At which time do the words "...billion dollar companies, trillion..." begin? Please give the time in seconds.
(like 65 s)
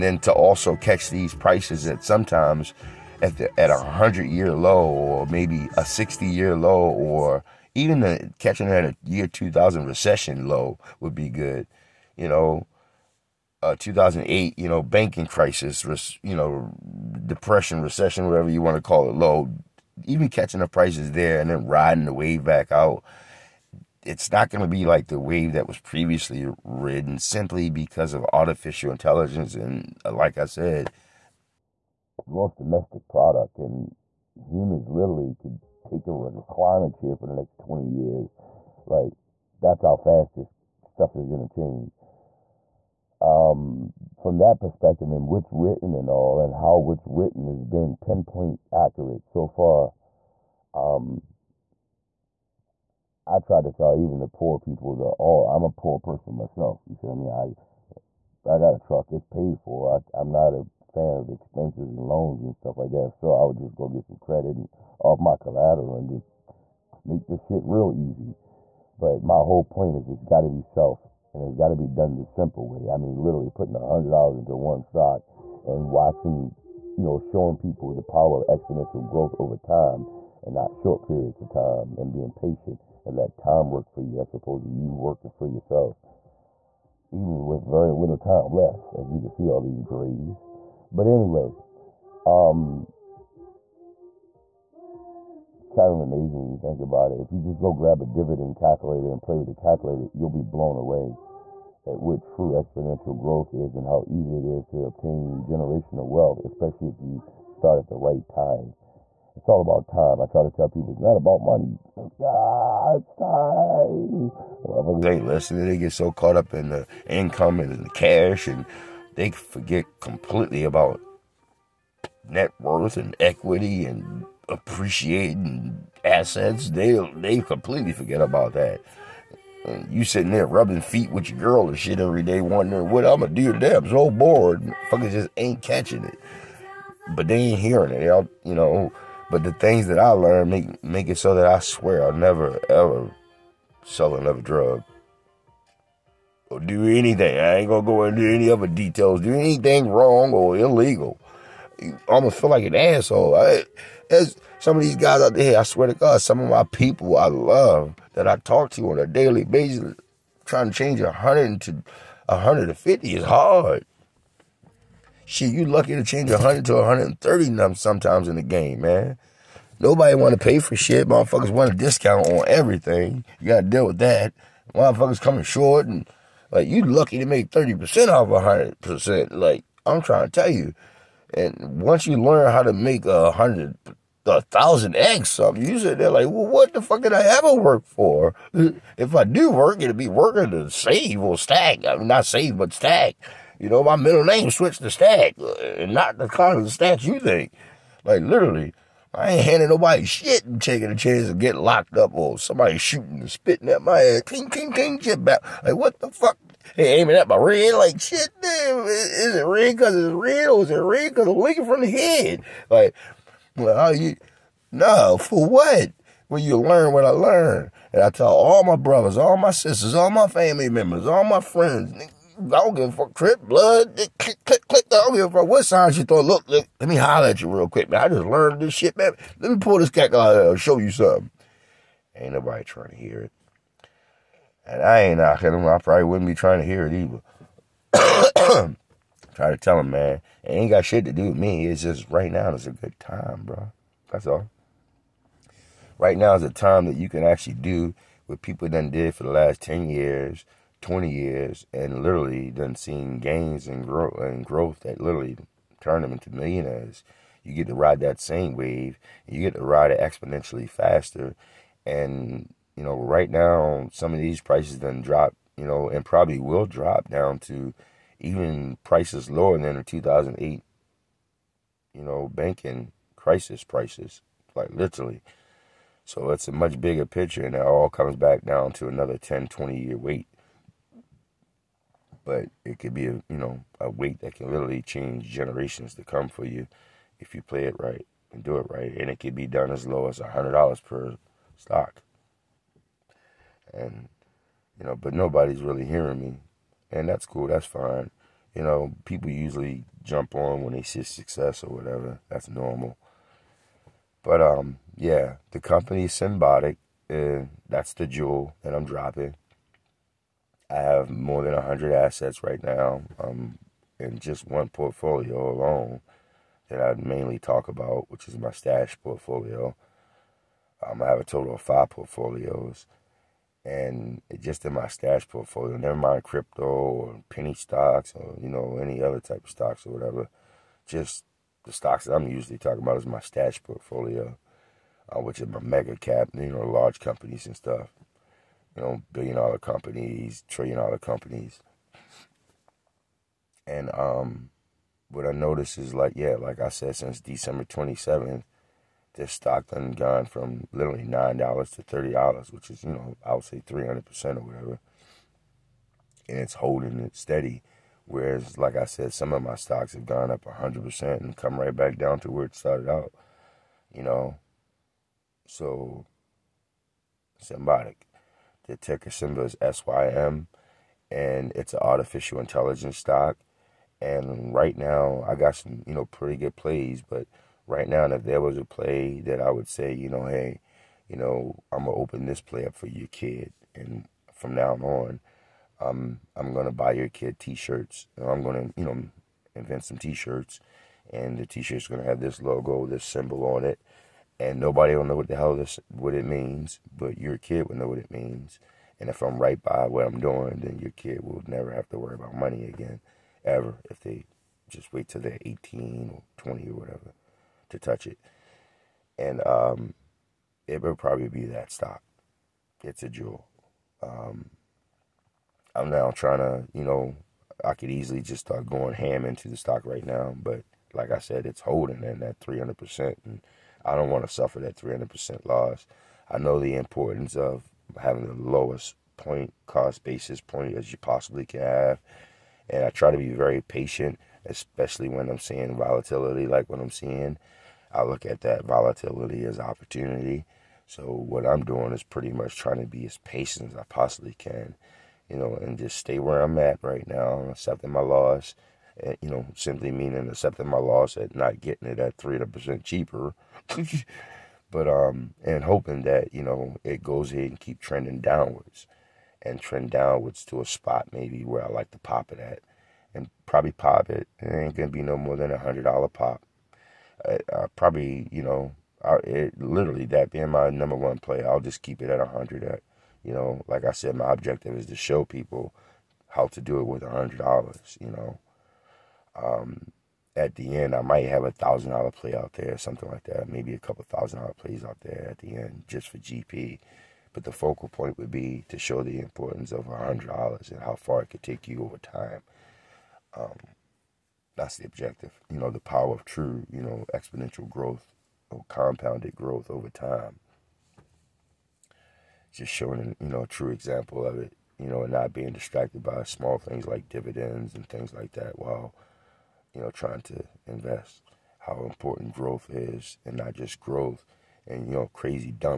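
339 s.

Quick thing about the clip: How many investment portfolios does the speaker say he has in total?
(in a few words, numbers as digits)
5.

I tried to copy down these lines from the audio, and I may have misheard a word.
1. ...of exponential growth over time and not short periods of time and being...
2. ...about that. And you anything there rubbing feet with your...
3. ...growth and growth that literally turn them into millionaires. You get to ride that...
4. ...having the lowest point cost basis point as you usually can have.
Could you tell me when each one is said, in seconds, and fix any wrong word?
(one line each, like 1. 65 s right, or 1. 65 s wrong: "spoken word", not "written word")
1. 78 s right
2. 128 s wrong: "sitting", not "anything"
3. 253 s right
4. 428 s wrong: "possibly", not "usually".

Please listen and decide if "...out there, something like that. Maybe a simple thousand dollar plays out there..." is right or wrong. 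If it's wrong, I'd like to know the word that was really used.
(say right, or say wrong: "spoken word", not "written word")
wrong: "couple", not "simple".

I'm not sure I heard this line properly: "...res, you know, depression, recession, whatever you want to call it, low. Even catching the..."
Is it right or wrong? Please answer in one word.
right.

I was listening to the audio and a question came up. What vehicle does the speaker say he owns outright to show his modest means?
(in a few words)
truck.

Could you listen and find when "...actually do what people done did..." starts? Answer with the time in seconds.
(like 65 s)
247 s.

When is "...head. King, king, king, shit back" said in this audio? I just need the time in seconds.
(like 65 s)
203 s.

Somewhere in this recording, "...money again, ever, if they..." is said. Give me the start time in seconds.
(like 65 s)
402 s.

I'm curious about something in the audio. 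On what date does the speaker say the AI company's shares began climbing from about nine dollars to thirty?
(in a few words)
December 27.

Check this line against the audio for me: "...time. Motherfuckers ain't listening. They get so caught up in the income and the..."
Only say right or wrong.
right.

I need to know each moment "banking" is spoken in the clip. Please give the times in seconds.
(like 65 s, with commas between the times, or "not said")
14 s, 272 s.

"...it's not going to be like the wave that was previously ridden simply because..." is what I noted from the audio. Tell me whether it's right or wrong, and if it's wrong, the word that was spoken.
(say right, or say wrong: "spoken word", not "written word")
right.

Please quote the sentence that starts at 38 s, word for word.
Like, that's how fast this stuff is going to change.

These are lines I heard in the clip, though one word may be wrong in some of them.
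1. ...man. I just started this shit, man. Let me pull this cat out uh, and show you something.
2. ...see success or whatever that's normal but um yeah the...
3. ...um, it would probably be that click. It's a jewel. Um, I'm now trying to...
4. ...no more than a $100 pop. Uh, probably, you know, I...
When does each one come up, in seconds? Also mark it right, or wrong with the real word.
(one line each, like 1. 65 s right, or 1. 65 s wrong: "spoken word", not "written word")
1. 227 s wrong: "learned", not "started"
2. 300 s right
3. 409 s wrong: "stock", not "click"
4. 465 s right.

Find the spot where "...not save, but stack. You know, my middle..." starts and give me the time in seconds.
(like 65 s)
192 s.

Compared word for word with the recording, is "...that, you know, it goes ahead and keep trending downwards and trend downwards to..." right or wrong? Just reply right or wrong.
right.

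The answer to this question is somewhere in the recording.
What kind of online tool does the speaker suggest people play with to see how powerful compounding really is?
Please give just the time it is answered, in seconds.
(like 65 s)
98 s.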